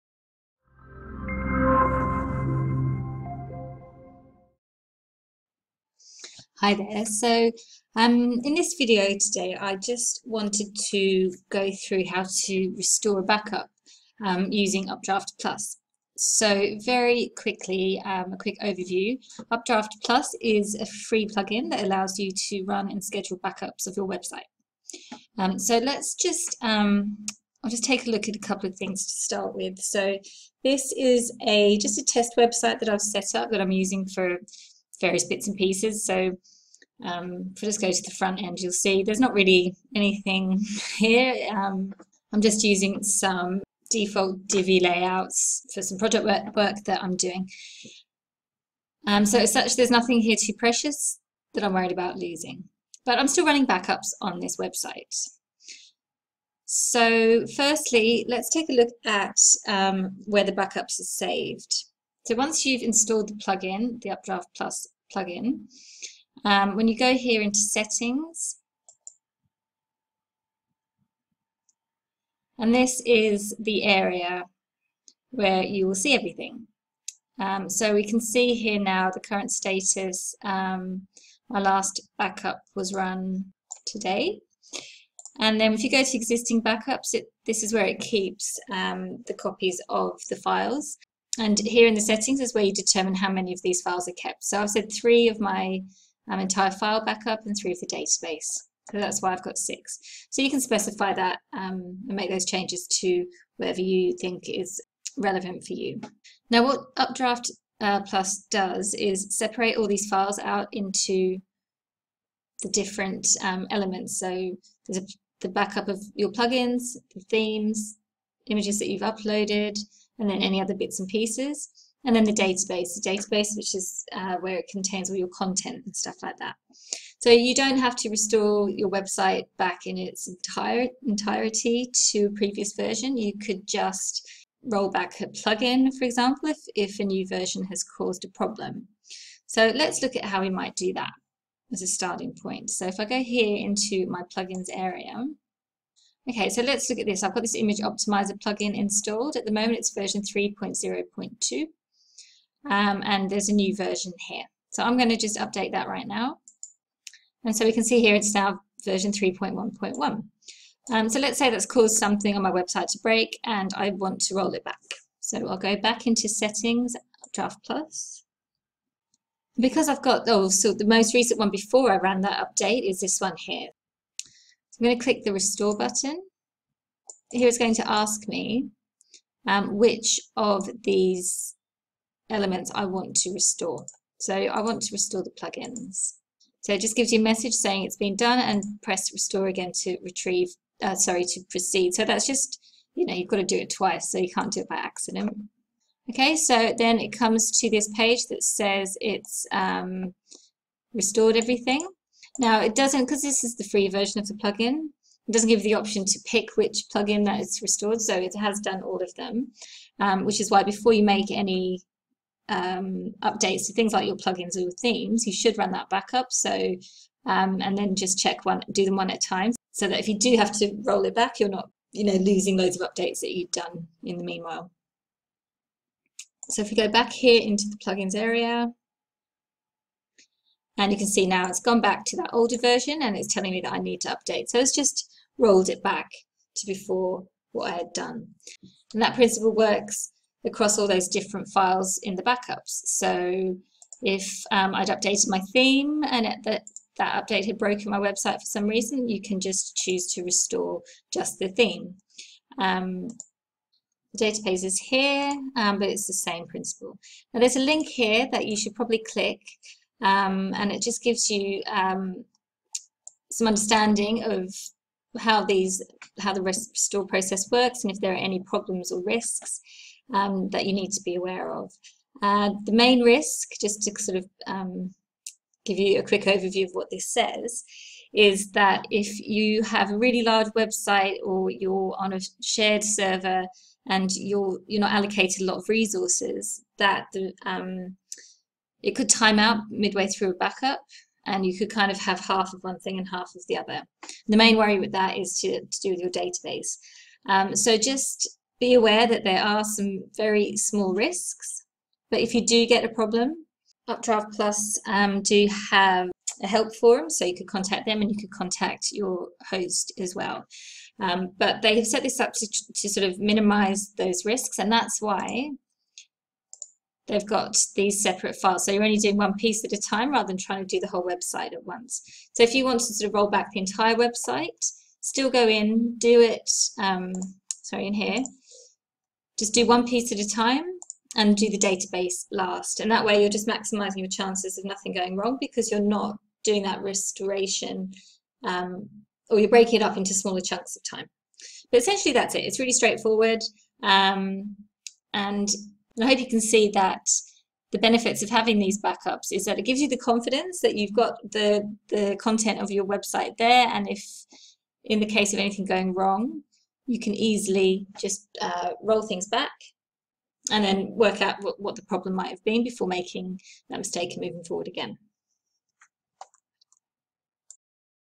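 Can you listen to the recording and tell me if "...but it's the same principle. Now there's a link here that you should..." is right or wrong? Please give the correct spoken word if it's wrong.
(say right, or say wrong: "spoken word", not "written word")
right.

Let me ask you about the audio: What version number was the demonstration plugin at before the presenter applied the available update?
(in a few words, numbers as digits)
3.0.2.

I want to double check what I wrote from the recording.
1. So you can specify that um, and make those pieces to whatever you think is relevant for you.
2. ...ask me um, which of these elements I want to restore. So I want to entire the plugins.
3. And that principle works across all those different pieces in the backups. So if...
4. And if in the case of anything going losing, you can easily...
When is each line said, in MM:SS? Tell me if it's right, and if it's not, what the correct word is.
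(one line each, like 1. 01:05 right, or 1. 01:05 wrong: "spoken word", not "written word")
1. 01:40 wrong: "changes", not "pieces"
2. 02:57 wrong: "restore", not "entire"
3. 03:58 wrong: "files", not "pieces"
4. 05:53 wrong: "wrong", not "losing".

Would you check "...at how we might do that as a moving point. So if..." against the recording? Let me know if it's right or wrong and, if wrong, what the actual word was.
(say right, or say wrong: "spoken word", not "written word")
wrong: "starting", not "moving".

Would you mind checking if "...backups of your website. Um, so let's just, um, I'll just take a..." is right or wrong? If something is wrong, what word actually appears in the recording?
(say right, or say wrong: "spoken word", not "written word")
right.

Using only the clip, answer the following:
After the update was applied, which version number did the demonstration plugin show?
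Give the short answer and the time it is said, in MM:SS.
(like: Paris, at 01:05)
3.1.1, at 02:39.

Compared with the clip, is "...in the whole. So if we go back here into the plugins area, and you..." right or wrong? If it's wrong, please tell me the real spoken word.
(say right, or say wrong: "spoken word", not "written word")
wrong: "meanwhile", not "whole".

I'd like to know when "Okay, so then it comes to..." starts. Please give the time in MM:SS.
03:16.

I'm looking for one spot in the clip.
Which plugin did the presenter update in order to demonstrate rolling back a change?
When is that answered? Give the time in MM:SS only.
02:27.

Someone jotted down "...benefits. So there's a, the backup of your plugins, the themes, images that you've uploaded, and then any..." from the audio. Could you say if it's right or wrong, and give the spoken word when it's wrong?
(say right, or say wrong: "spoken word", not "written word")
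wrong: "elements", not "benefits".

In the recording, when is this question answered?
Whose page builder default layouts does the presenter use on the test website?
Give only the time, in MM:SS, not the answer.
00:44.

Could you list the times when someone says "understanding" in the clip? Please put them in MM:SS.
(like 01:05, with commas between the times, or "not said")
04:23.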